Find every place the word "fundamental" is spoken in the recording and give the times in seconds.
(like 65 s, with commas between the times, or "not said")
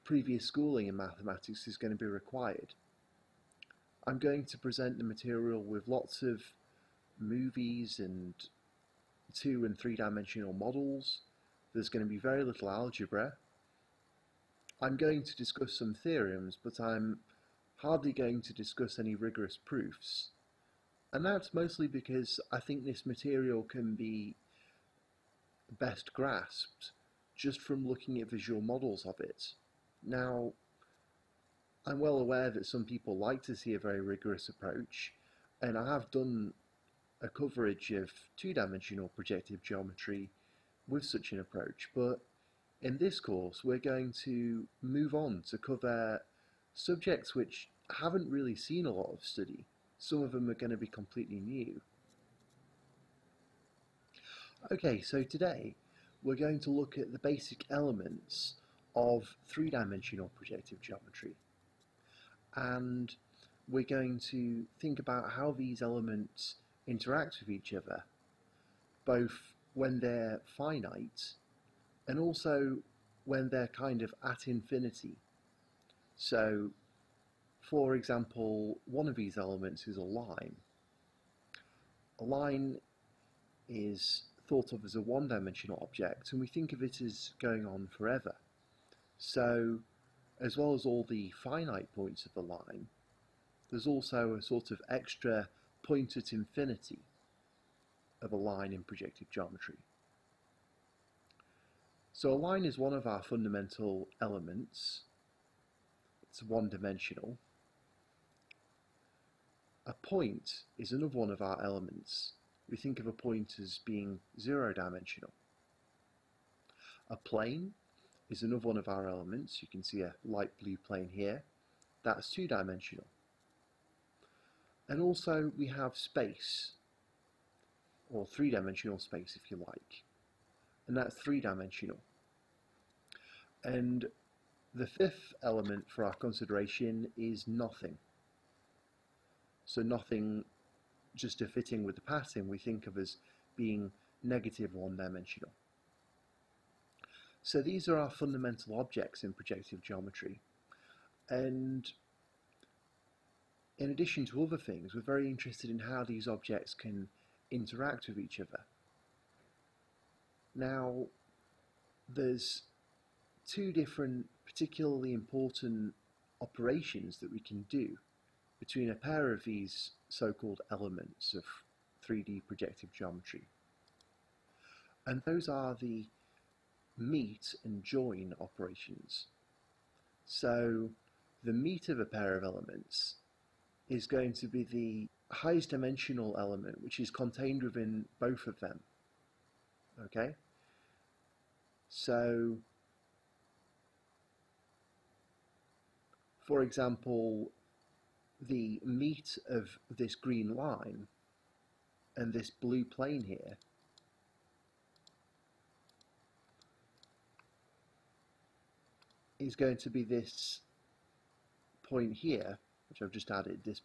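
103 s, 148 s.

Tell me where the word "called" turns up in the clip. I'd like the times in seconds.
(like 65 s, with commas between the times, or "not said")
170 s.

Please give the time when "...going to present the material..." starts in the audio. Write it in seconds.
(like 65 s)
4 s.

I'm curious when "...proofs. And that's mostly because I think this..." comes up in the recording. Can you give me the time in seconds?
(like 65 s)
19 s.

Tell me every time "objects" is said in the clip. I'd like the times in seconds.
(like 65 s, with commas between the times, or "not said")
85 s, 148 s, 156 s.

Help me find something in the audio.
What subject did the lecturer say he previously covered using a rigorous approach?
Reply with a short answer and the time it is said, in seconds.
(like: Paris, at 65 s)
two-dimensional projective geometry, at 38 s.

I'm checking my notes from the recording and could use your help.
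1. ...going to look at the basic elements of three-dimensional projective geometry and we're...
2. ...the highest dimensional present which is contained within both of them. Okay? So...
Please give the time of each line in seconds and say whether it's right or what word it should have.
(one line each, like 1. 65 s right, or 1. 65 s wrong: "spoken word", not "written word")
1. 56 s right
2. 184 s wrong: "element", not "present".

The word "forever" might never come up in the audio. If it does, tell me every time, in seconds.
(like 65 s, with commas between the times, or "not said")
87 s.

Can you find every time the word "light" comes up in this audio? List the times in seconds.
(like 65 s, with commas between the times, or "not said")
120 s.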